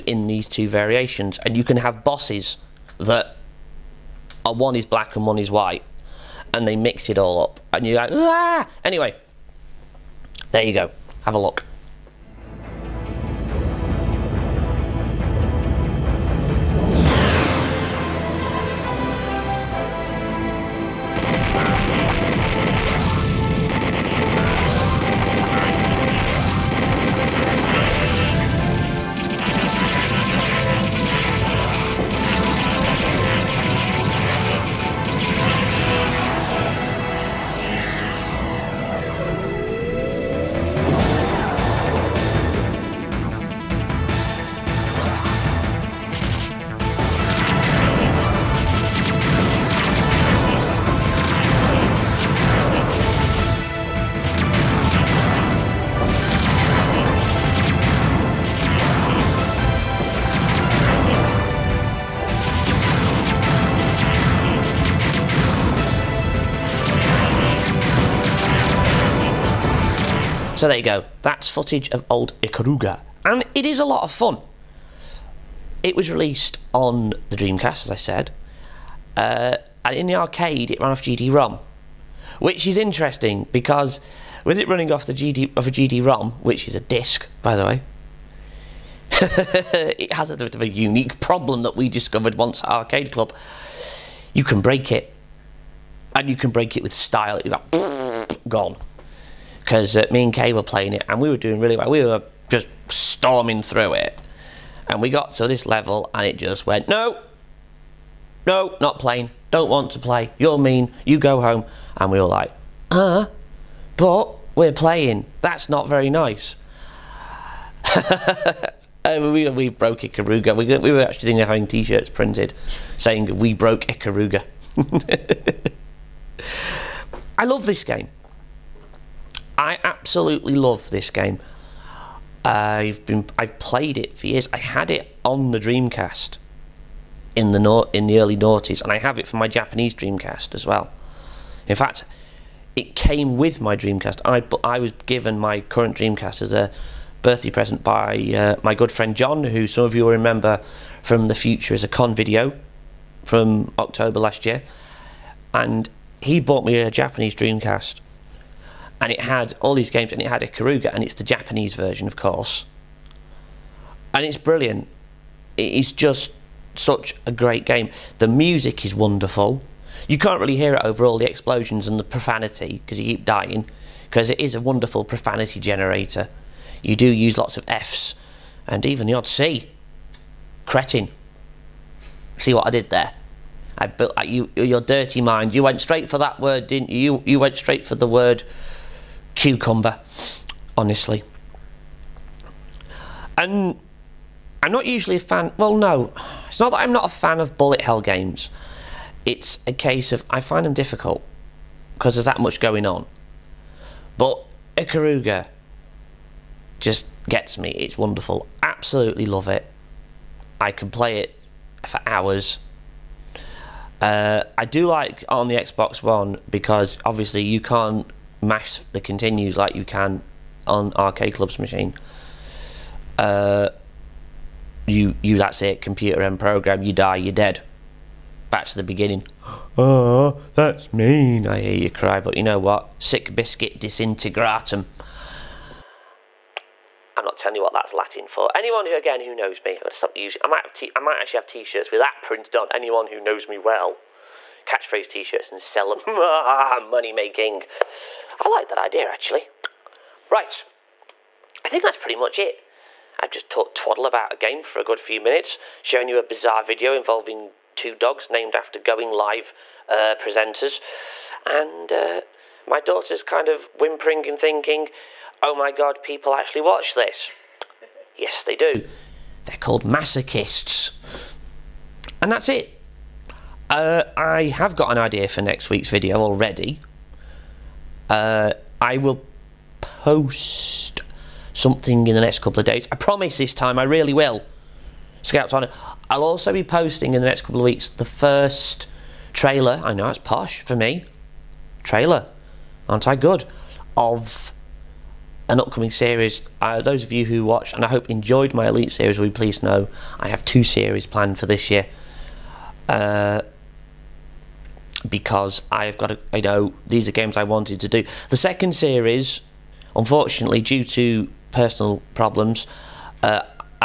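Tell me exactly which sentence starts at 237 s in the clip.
I'm not telling you what that's Latin for.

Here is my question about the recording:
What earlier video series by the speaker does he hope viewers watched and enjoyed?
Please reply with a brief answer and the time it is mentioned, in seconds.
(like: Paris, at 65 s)
Elite, at 298 s.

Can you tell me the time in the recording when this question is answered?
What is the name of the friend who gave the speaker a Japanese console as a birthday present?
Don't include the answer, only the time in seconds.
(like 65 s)
149 s.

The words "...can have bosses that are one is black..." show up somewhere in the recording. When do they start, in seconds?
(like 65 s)
1 s.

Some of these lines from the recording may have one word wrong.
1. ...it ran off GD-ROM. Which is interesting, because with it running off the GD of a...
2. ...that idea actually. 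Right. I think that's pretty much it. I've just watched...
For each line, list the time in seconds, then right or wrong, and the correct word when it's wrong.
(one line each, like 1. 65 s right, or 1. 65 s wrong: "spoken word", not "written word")
1. 80 s right
2. 248 s wrong: "talked", not "watched".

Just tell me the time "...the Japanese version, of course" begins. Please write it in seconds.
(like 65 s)
161 s.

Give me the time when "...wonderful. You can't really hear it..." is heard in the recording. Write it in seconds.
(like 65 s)
168 s.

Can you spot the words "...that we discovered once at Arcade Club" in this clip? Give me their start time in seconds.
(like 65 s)
91 s.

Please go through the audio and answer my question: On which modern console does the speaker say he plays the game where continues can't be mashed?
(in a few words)
Xbox One.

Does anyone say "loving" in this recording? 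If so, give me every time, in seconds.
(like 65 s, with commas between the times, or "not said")
not said.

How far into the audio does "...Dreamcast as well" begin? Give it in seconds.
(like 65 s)
139 s.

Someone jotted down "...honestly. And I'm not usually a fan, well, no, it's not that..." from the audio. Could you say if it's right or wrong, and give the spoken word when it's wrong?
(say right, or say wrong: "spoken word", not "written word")
right.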